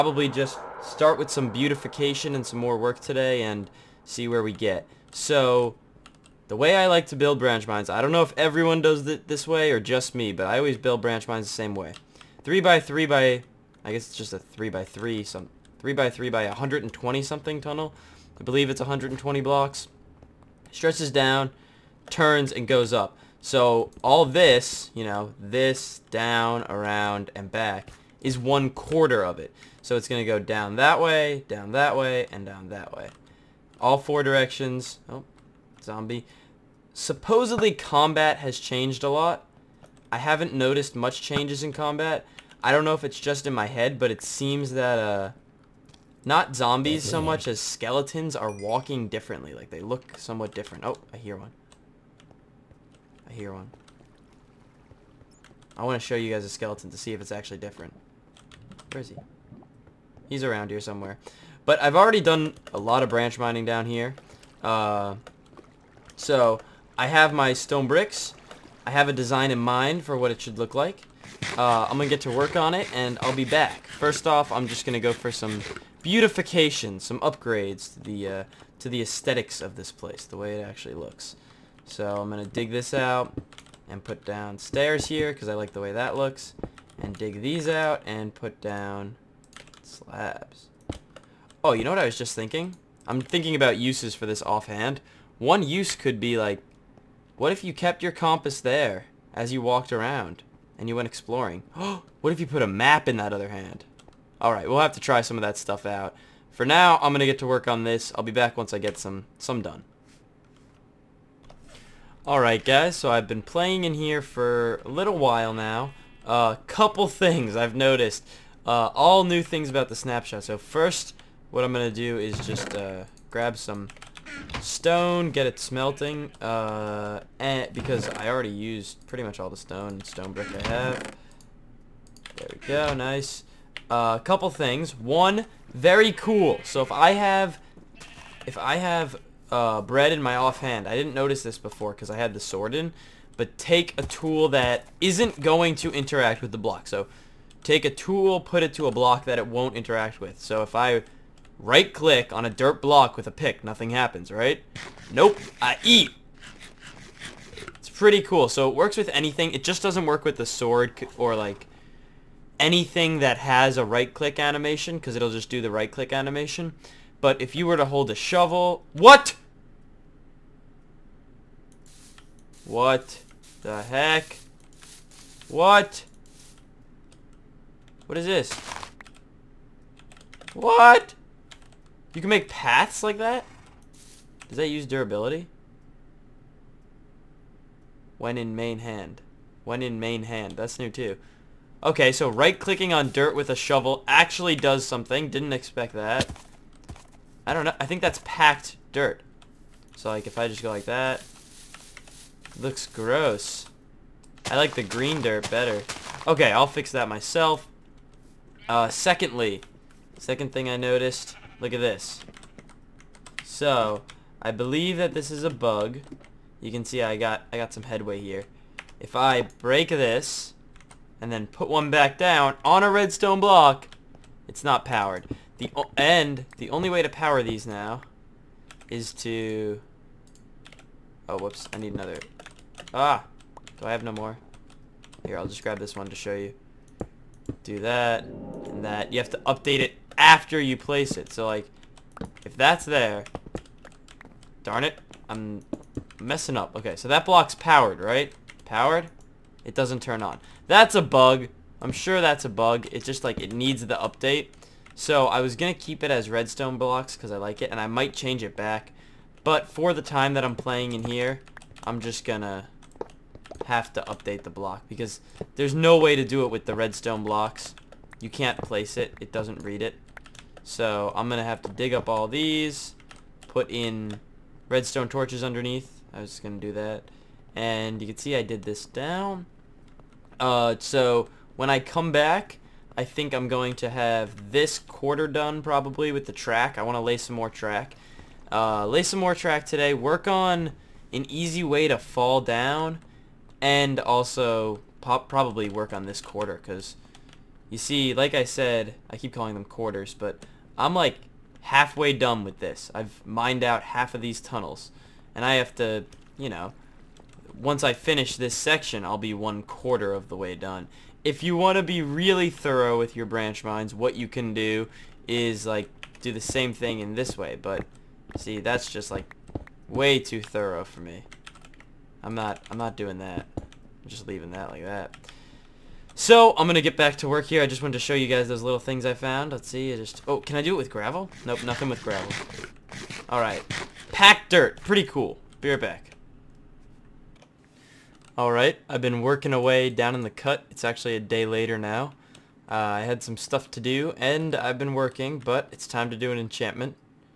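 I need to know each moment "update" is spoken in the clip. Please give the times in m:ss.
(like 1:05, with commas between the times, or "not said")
3:59, 4:13, 4:24.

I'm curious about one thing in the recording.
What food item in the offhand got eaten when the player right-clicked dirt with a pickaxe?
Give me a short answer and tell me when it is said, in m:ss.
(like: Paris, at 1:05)
bread, at 2:19.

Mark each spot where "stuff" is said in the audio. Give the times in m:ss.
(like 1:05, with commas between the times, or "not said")
1:45, 5:43.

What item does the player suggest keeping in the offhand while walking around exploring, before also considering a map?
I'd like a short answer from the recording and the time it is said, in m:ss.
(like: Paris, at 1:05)
compass, at 1:38.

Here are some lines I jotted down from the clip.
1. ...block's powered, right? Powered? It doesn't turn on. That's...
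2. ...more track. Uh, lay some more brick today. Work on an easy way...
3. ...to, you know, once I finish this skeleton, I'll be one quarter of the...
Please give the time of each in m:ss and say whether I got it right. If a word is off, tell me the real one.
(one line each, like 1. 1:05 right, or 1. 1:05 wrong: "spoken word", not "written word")
1. 4:07 right
2. 4:47 wrong: "track", not "brick"
3. 5:05 wrong: "section", not "skeleton".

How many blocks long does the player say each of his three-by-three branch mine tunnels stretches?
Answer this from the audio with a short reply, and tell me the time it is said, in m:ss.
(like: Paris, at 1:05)
120, at 0:18.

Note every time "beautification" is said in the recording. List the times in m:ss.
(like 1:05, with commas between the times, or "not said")
0:01, 1:16.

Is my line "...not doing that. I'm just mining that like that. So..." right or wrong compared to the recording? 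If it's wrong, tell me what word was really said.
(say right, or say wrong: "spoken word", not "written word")
wrong: "leaving", not "mining".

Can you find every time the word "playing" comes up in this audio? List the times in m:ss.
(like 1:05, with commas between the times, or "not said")
1:53, 4:20.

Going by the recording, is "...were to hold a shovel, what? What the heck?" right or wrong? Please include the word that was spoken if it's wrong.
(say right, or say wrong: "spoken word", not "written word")
right.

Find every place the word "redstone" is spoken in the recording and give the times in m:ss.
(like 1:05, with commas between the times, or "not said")
3:42, 4:16, 4:26, 4:34.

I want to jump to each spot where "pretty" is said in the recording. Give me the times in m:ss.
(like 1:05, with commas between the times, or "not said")
2:09, 2:37, 5:34.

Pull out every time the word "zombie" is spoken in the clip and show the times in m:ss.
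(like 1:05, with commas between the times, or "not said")
0:35, 0:46.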